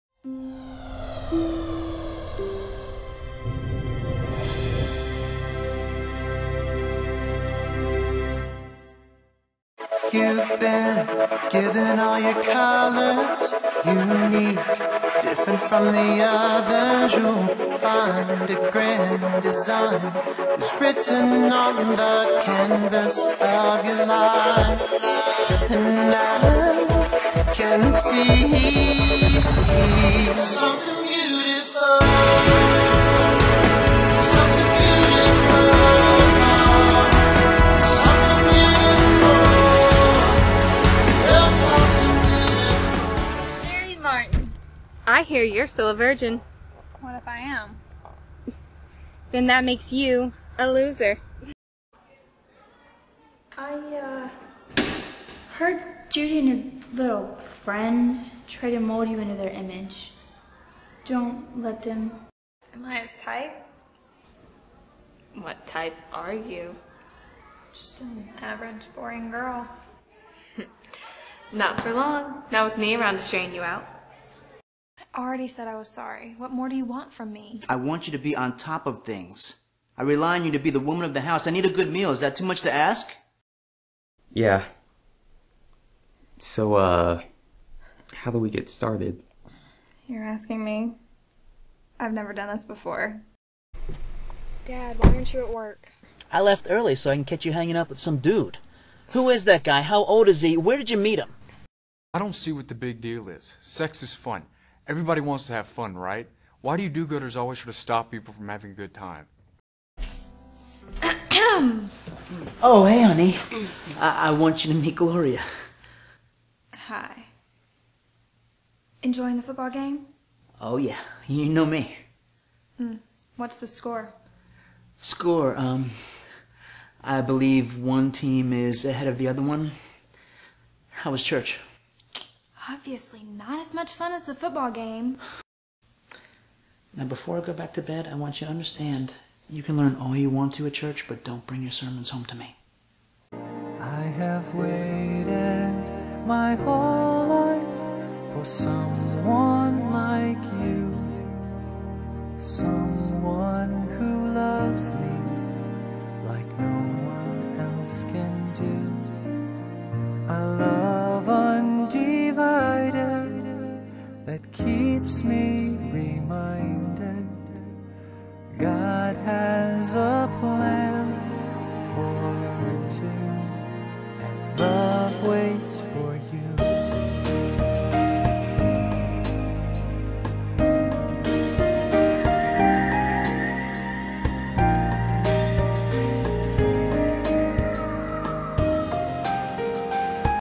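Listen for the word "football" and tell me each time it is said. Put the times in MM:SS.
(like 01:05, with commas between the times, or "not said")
01:59, 02:14.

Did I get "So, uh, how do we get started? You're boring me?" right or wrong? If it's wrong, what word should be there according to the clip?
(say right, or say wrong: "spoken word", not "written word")
wrong: "asking", not "boring".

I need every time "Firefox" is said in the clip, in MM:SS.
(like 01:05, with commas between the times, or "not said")
not said.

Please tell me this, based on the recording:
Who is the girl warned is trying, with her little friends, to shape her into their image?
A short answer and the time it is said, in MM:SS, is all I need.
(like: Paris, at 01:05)
Judy, at 00:56.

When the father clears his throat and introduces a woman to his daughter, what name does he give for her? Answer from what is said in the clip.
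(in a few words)
Gloria.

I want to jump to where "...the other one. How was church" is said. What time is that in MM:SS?
02:09.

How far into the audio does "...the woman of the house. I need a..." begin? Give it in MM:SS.
01:20.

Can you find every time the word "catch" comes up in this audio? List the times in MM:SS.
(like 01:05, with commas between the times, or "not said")
01:37.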